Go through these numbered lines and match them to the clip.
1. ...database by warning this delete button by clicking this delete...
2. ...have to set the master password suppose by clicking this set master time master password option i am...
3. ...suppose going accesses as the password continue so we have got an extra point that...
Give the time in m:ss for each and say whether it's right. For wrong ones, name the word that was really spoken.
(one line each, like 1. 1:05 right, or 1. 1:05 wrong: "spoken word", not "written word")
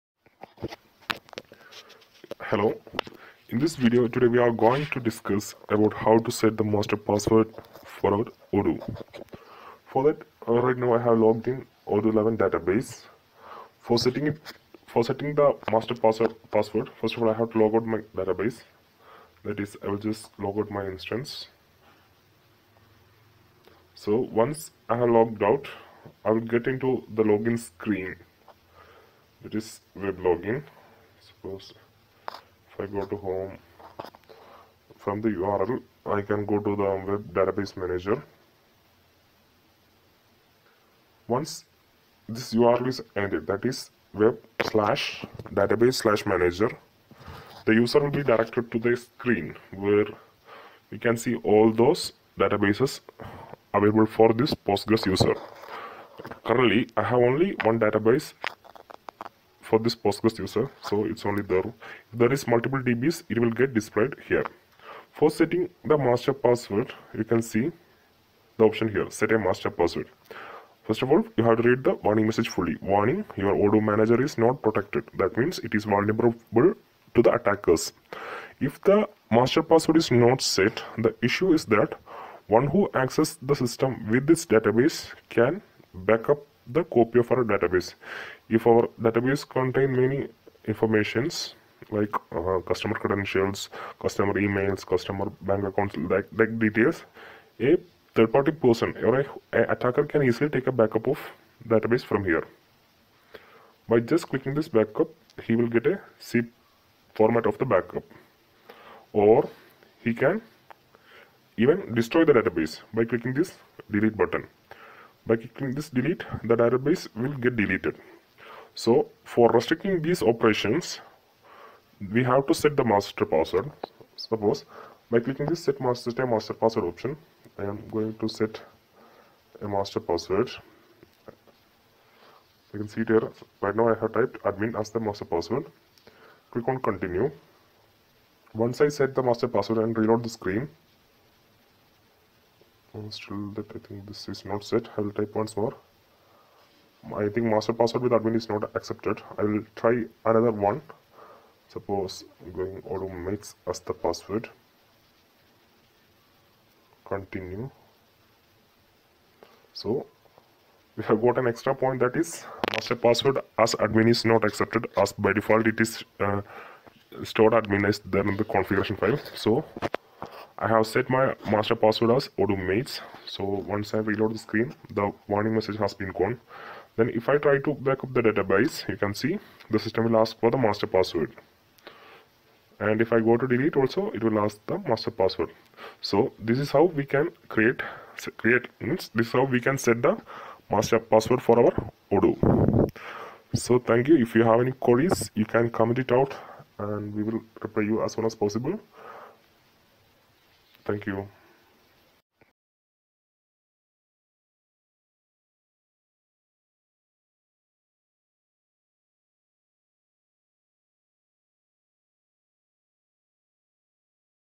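1. 1:52 wrong: "clicking", not "warning"
2. 2:02 right
3. 2:31 wrong: "automates", not "accesses".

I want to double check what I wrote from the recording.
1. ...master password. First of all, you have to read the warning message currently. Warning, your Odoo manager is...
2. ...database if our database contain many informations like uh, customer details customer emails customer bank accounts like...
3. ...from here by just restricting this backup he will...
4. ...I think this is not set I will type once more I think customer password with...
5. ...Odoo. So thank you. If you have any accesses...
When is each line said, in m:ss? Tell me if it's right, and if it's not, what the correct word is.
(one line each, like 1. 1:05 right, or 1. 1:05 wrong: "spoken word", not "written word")
1. 1:09 wrong: "fully", not "currently"
2. 1:27 wrong: "credentials", not "details"
3. 1:42 wrong: "clicking", not "restricting"
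4. 2:23 wrong: "master", not "customer"
5. 3:12 wrong: "queries", not "accesses".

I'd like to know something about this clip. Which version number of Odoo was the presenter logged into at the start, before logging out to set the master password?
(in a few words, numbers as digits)
11.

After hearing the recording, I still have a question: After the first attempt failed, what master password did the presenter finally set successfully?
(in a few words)
mates.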